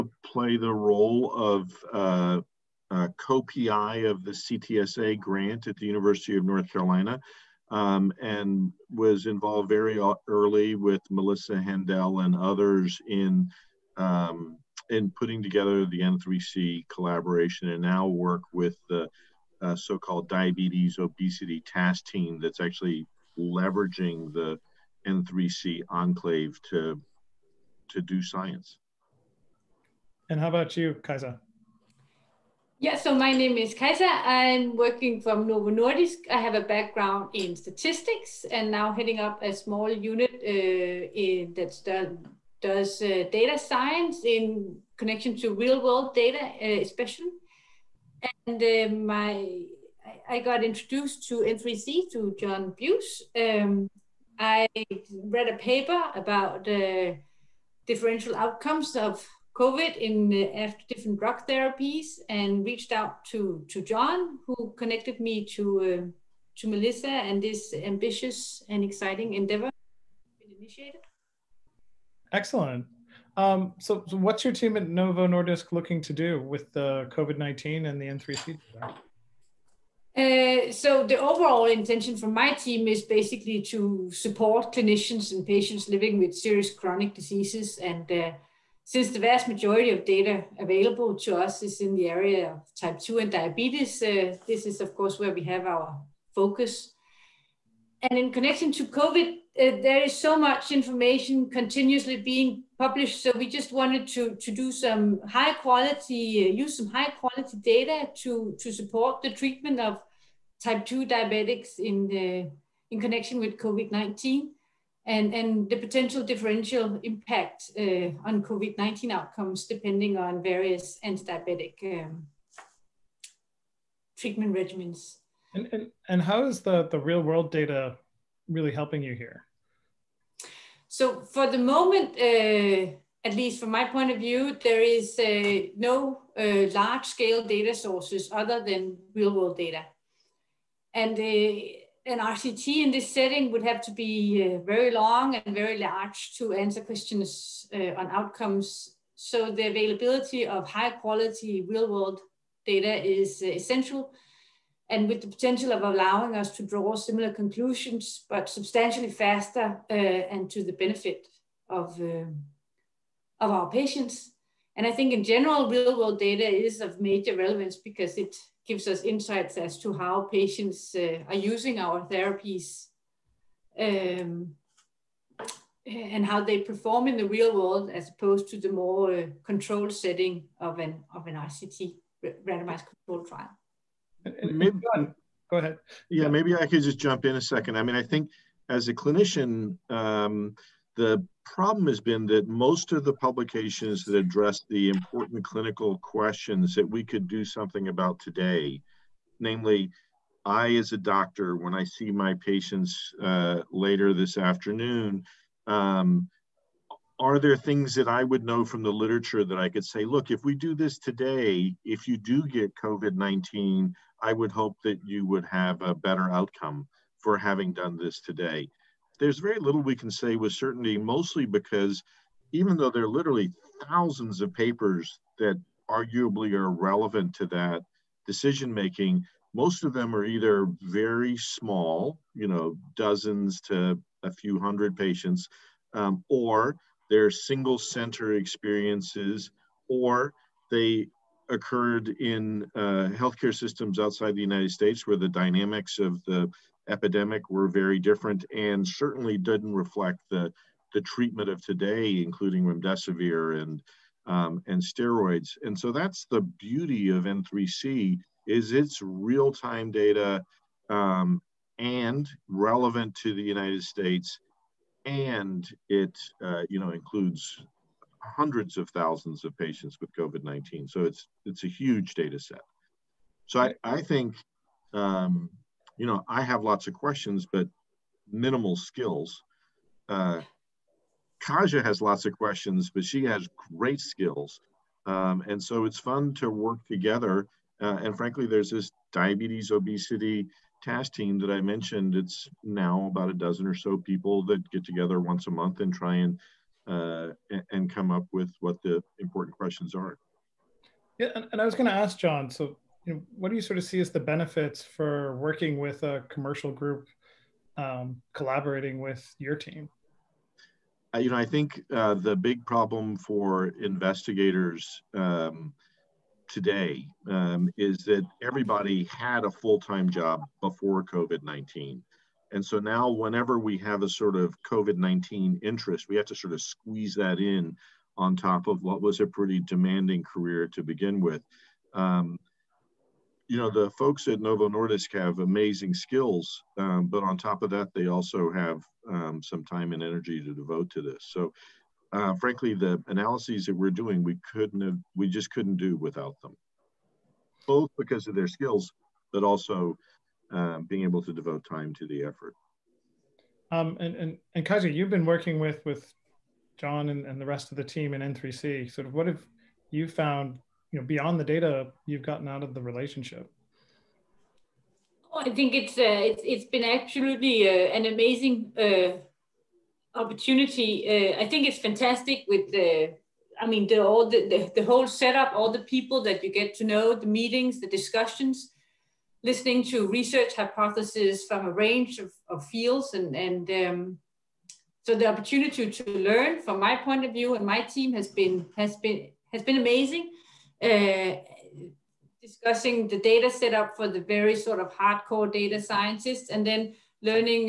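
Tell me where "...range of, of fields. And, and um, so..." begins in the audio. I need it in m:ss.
6:21.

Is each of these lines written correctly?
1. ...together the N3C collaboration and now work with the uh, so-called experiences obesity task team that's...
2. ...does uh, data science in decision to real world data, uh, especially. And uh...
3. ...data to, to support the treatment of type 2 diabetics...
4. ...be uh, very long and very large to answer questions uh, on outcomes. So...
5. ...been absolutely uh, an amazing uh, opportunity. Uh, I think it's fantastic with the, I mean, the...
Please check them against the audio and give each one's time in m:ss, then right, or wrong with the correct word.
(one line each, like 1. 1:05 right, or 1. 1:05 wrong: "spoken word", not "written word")
1. 0:15 wrong: "diabetes", not "experiences"
2. 0:42 wrong: "connection", not "decision"
3. 1:47 right
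4. 2:23 right
5. 6:06 right.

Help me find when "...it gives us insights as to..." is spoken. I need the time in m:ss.
2:48.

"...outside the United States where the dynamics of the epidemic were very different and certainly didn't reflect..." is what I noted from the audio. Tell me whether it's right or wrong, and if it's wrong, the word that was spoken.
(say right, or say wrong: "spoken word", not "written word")
right.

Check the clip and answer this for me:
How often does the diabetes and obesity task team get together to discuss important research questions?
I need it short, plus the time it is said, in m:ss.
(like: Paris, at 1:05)
once a month, at 4:55.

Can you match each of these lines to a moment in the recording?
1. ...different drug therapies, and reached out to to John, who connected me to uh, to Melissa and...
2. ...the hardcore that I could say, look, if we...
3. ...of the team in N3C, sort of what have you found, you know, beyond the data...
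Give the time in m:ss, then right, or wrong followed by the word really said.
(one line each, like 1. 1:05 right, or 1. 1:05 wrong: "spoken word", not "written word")
1. 1:00 right
2. 3:28 wrong: "literature", not "hardcore"
3. 5:57 right.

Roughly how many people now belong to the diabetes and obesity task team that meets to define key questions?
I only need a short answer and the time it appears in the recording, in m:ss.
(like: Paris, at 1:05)
about a dozen, at 4:53.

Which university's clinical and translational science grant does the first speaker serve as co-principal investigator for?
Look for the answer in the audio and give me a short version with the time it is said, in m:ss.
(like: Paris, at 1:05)
University of North Carolina, at 0:05.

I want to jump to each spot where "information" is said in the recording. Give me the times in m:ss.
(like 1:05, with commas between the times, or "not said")
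1:40.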